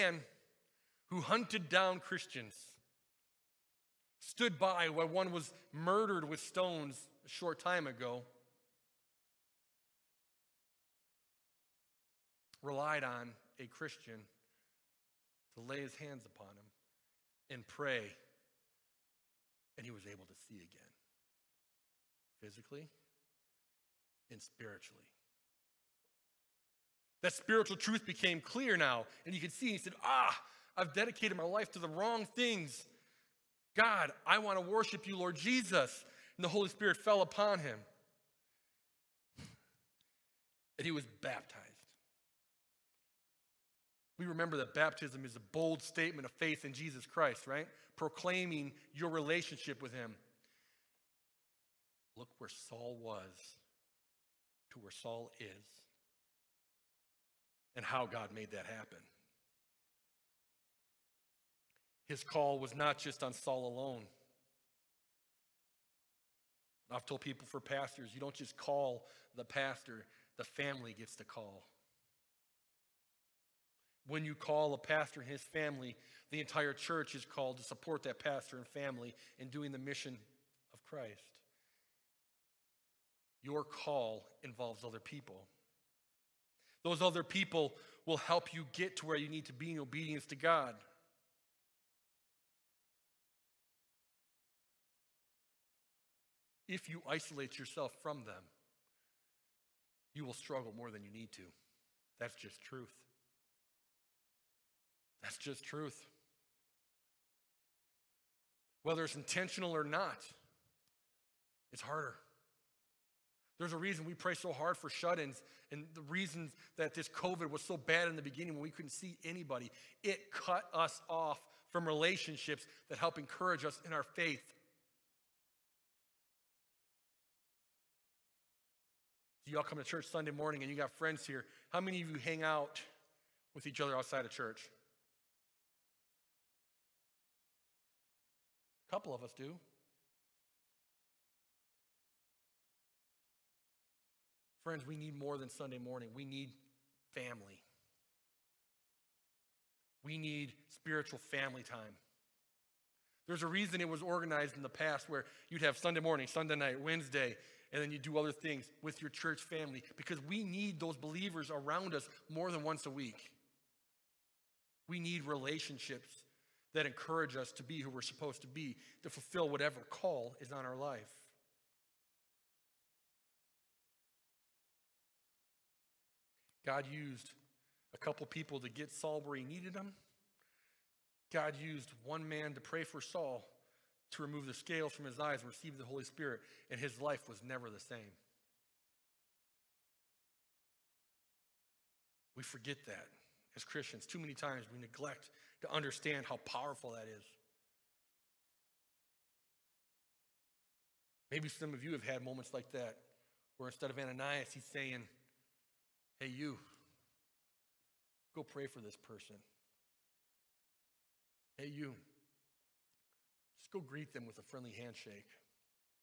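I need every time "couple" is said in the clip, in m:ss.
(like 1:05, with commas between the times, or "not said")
2:18, 2:57.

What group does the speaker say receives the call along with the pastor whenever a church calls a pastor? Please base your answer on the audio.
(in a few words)
the family.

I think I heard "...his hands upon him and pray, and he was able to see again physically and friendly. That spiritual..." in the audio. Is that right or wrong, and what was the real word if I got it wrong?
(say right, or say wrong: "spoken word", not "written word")
wrong: "spiritually", not "friendly".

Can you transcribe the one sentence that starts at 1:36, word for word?
If you isolate yourself from them, you will struggle more than you need to.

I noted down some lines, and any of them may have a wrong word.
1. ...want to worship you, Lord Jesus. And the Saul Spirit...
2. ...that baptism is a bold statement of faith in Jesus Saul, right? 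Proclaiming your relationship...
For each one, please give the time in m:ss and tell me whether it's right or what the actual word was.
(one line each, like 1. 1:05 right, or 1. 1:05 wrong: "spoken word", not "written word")
1. 0:34 wrong: "Holy", not "Saul"
2. 0:44 wrong: "Christ", not "Saul".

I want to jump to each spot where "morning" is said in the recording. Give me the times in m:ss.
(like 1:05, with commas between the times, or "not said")
2:10, 2:25, 2:35.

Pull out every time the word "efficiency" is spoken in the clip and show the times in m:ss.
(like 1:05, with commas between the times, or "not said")
not said.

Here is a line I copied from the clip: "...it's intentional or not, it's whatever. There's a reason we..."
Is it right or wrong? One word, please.
wrong.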